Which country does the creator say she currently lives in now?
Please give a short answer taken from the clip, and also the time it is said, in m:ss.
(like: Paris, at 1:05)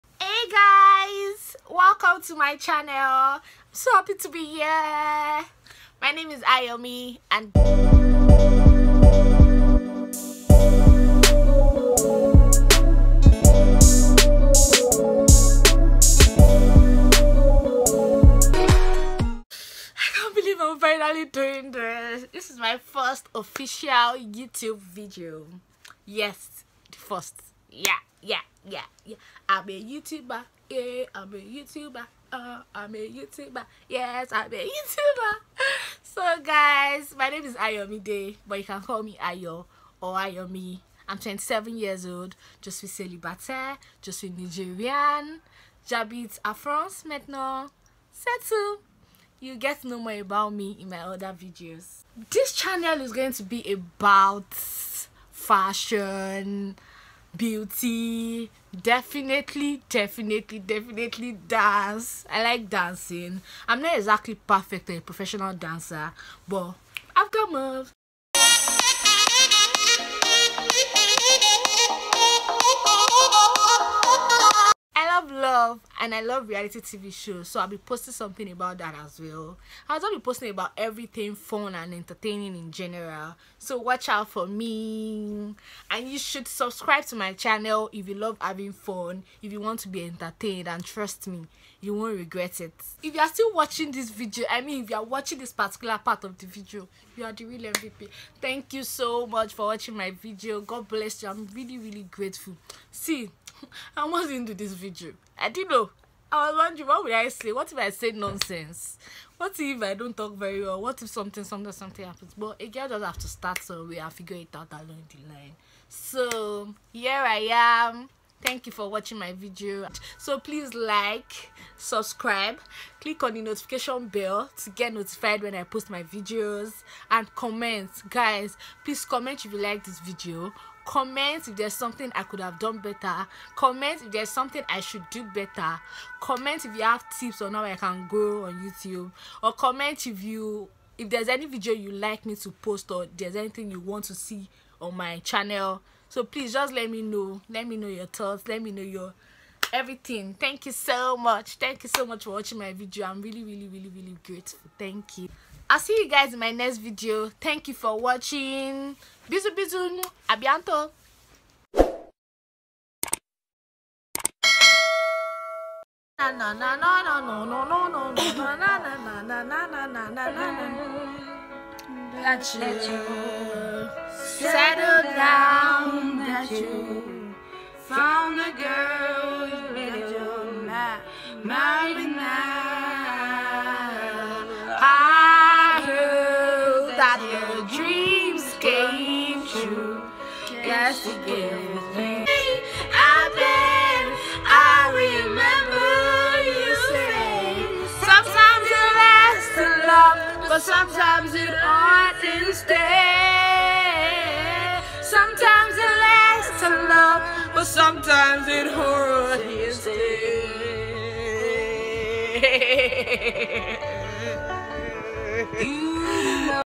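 France, at 0:46.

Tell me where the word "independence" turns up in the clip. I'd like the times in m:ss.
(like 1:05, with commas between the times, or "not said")
not said.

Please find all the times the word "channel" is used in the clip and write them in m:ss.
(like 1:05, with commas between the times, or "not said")
0:02, 0:52, 1:27, 2:25.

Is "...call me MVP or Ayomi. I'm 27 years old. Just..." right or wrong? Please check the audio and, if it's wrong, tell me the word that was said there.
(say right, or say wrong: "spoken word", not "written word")
wrong: "Ayo", not "MVP".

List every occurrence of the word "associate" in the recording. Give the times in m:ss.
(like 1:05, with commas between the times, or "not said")
not said.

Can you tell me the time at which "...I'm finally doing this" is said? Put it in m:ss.
0:20.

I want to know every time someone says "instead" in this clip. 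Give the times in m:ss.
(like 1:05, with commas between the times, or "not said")
3:22, 3:36.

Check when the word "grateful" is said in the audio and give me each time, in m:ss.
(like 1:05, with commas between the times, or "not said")
1:42, 2:34.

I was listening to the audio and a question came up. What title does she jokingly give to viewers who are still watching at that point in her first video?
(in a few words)
The real MVP.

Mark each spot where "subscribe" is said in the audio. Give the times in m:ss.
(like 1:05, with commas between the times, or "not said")
1:26, 2:01.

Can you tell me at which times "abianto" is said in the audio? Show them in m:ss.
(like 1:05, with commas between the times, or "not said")
2:40.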